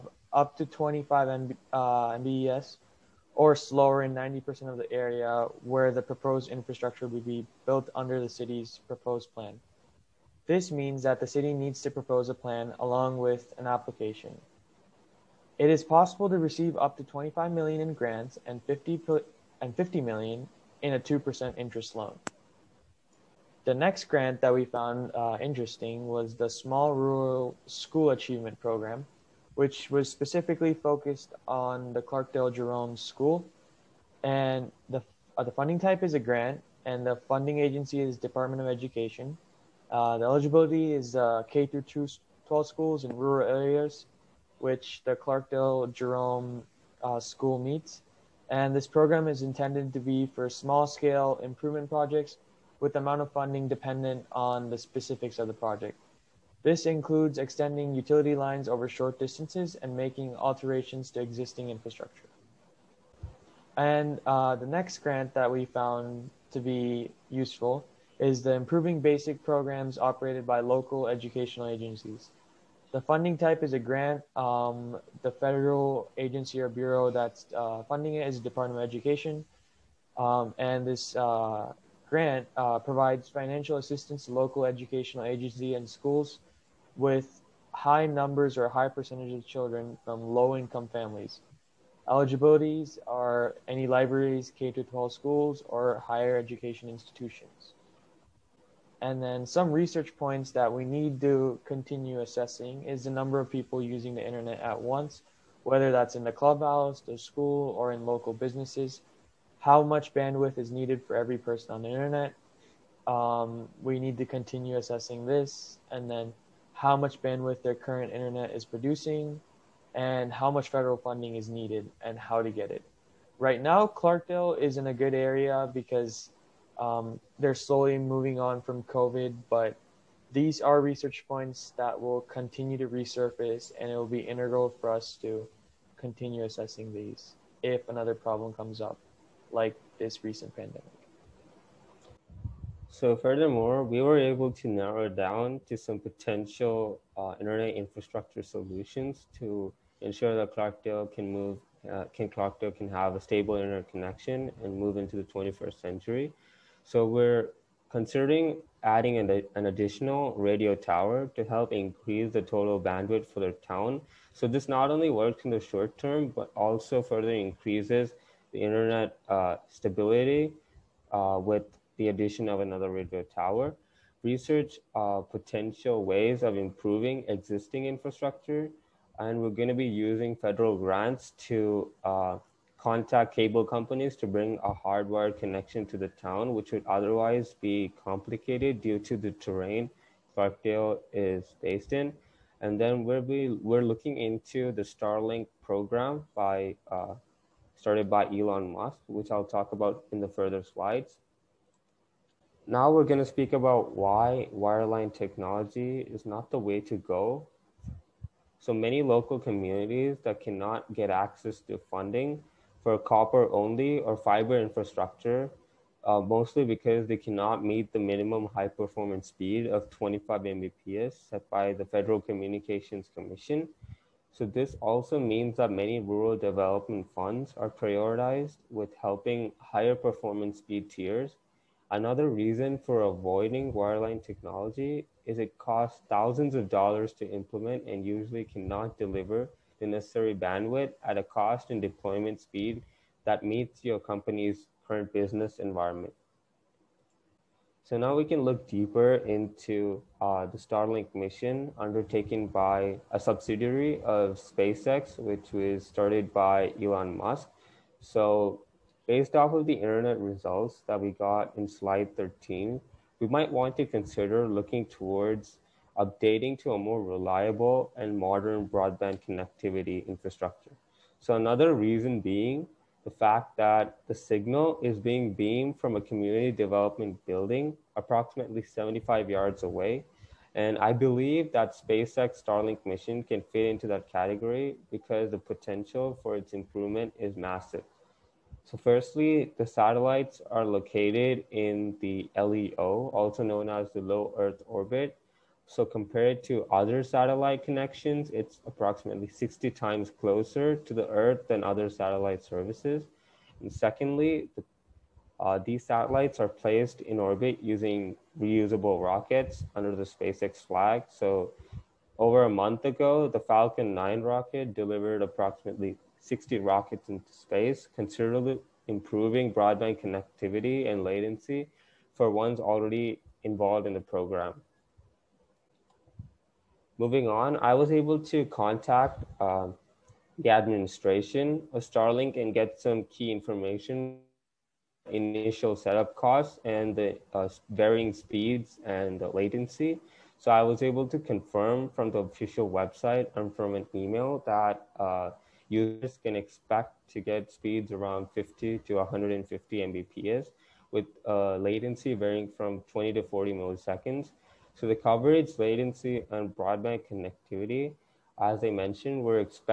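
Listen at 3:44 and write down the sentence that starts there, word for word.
So this also means that many rural development funds are prioritized with helping higher performance speed tiers.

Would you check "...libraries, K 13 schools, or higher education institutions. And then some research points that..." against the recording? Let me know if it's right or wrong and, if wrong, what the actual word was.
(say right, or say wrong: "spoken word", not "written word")
wrong: "12", not "13".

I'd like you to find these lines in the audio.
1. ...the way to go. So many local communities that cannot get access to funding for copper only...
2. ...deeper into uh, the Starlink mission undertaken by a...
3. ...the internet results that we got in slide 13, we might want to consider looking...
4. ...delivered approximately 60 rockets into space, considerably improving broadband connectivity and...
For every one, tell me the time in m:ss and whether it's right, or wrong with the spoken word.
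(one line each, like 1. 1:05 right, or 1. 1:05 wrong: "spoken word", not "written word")
1. 3:26 right
2. 4:08 right
3. 4:19 right
4. 5:14 right.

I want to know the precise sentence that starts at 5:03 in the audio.
And secondly, the, uh, these satellites are placed in orbit using reusable rockets under the SpaceX flag.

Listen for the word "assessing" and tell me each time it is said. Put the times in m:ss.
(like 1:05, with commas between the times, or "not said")
1:42, 1:54, 2:16.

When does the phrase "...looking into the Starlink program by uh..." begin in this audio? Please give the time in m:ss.
3:13.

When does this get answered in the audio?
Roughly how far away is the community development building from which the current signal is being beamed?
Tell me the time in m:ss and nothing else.
4:38.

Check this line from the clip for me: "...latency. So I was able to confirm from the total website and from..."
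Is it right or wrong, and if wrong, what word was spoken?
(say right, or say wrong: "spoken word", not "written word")
wrong: "official", not "total".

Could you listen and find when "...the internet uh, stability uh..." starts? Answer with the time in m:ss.
2:48.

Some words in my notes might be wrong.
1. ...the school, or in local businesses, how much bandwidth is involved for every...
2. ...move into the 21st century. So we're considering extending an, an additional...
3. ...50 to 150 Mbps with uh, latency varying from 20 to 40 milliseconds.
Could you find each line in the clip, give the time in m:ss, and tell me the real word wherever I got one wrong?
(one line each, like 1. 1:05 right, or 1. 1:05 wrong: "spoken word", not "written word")
1. 1:46 wrong: "needed", not "involved"
2. 2:34 wrong: "adding", not "extending"
3. 5:48 right.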